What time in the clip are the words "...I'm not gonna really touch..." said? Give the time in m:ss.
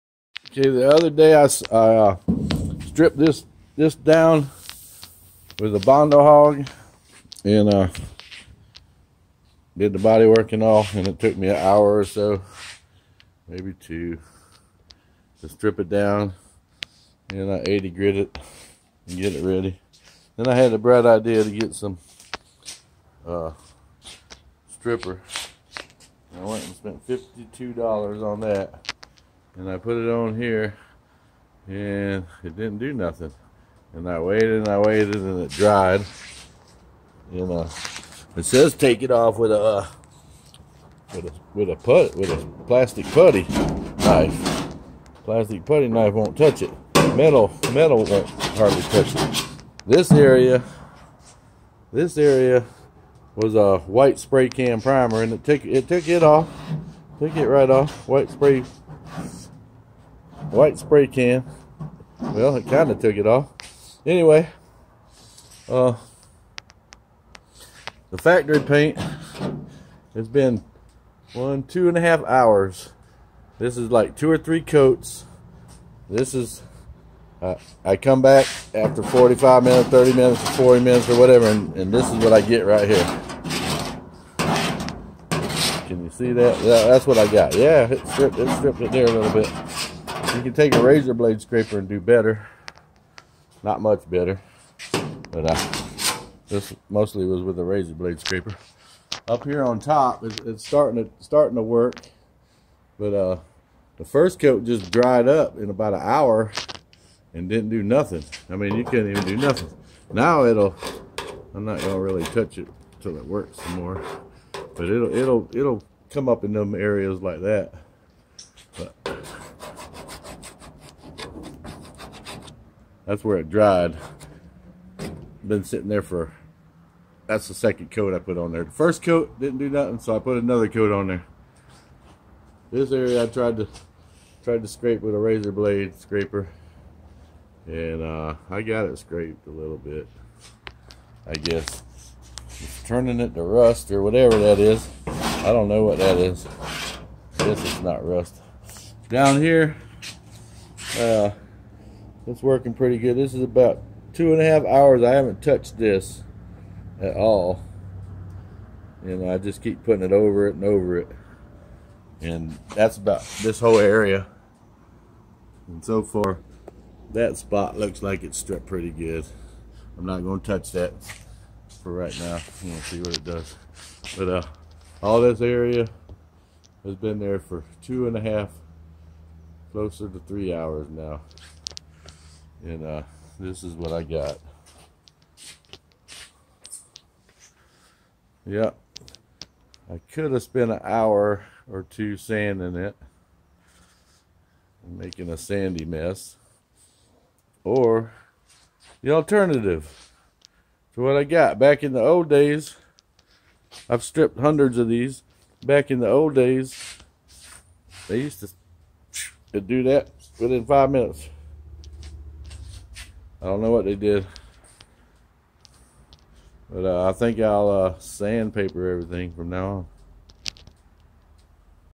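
1:51.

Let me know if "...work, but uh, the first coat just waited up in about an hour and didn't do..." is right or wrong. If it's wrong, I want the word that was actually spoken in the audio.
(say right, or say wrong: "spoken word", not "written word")
wrong: "dried", not "waited".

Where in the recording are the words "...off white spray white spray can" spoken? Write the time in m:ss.
0:57.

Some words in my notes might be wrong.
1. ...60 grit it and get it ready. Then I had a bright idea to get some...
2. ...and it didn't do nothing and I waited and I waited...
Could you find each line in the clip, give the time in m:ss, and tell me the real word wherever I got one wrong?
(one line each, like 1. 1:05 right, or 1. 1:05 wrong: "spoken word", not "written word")
1. 0:17 wrong: "80", not "60"
2. 0:31 right.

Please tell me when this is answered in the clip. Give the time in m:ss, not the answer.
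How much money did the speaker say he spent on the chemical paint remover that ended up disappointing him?
0:27.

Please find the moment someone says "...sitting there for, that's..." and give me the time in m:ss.
2:05.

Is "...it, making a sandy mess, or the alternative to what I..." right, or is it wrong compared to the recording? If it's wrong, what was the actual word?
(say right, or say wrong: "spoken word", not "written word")
right.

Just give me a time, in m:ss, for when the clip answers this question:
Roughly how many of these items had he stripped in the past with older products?
3:24.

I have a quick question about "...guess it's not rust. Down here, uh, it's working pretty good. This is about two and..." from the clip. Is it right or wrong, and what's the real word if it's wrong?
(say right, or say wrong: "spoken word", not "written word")
right.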